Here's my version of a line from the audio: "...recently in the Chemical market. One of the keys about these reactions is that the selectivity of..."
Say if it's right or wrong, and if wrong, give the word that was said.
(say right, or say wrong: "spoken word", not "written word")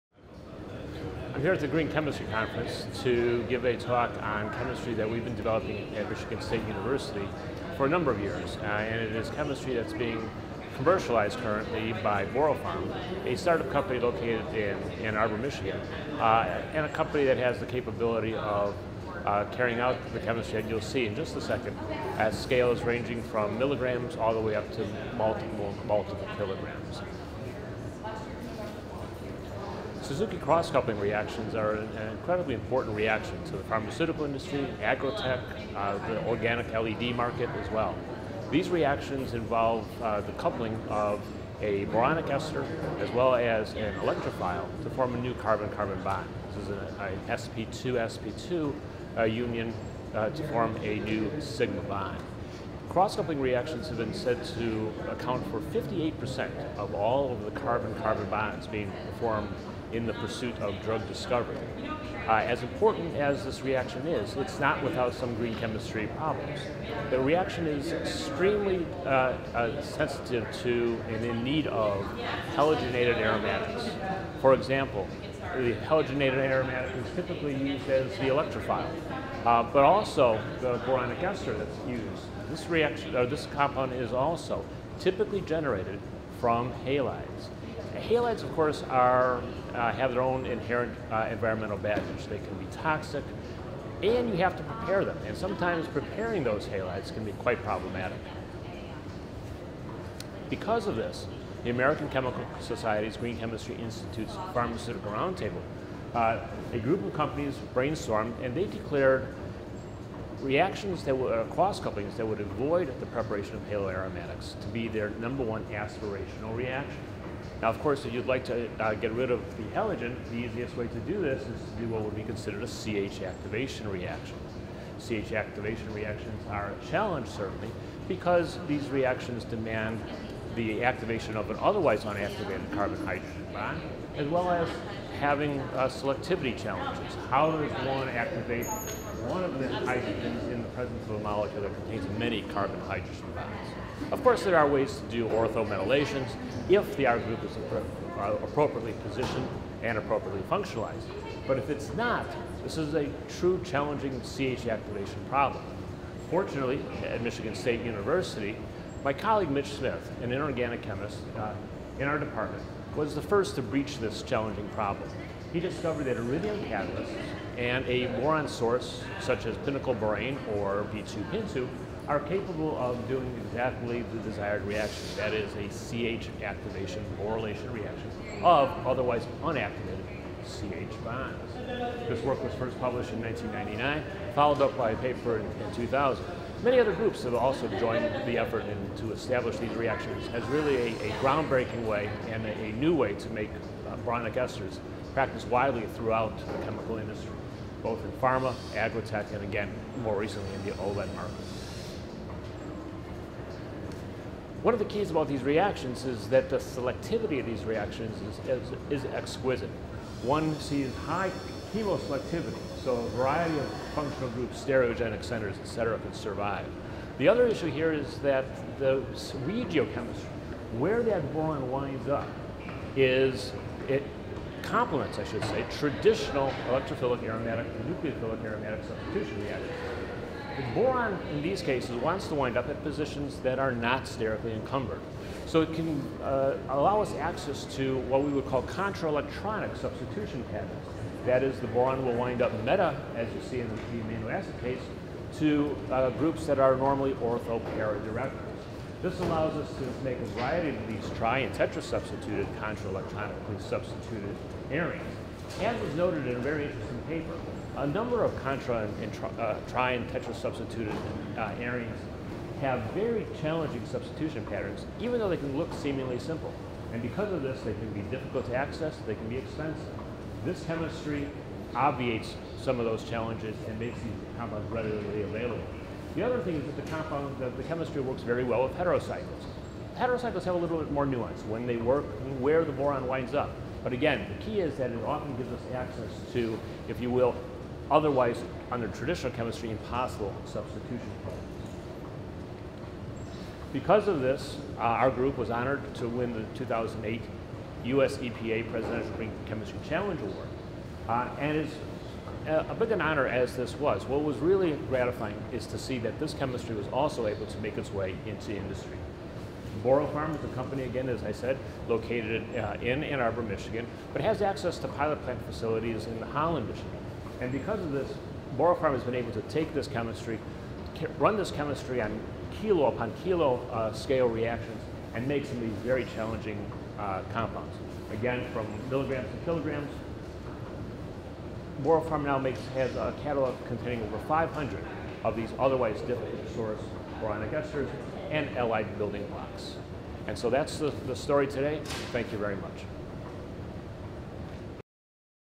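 wrong: "OLED", not "Chemical".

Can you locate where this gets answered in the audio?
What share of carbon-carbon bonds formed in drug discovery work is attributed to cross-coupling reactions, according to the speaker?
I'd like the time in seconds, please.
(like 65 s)
55 s.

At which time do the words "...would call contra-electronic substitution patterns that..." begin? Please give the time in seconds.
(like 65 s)
238 s.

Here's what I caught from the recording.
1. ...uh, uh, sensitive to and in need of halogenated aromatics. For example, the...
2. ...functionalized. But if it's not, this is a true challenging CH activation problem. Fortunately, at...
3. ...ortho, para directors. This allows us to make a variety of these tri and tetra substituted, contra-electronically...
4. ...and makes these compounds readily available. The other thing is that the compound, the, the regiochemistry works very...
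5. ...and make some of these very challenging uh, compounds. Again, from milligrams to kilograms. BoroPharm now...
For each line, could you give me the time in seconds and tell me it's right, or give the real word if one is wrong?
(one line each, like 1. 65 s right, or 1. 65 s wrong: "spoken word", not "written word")
1. 69 s right
2. 150 s right
3. 247 s right
4. 273 s wrong: "chemistry", not "regiochemistry"
5. 325 s right.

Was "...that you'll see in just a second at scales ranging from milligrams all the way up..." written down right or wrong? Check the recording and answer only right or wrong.
right.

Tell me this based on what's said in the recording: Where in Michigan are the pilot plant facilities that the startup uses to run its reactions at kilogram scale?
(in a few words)
Holland, Michigan.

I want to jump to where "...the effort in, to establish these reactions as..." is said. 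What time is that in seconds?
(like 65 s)
188 s.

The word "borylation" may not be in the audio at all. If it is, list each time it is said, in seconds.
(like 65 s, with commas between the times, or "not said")
177 s.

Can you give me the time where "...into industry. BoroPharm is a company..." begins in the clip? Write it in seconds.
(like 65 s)
308 s.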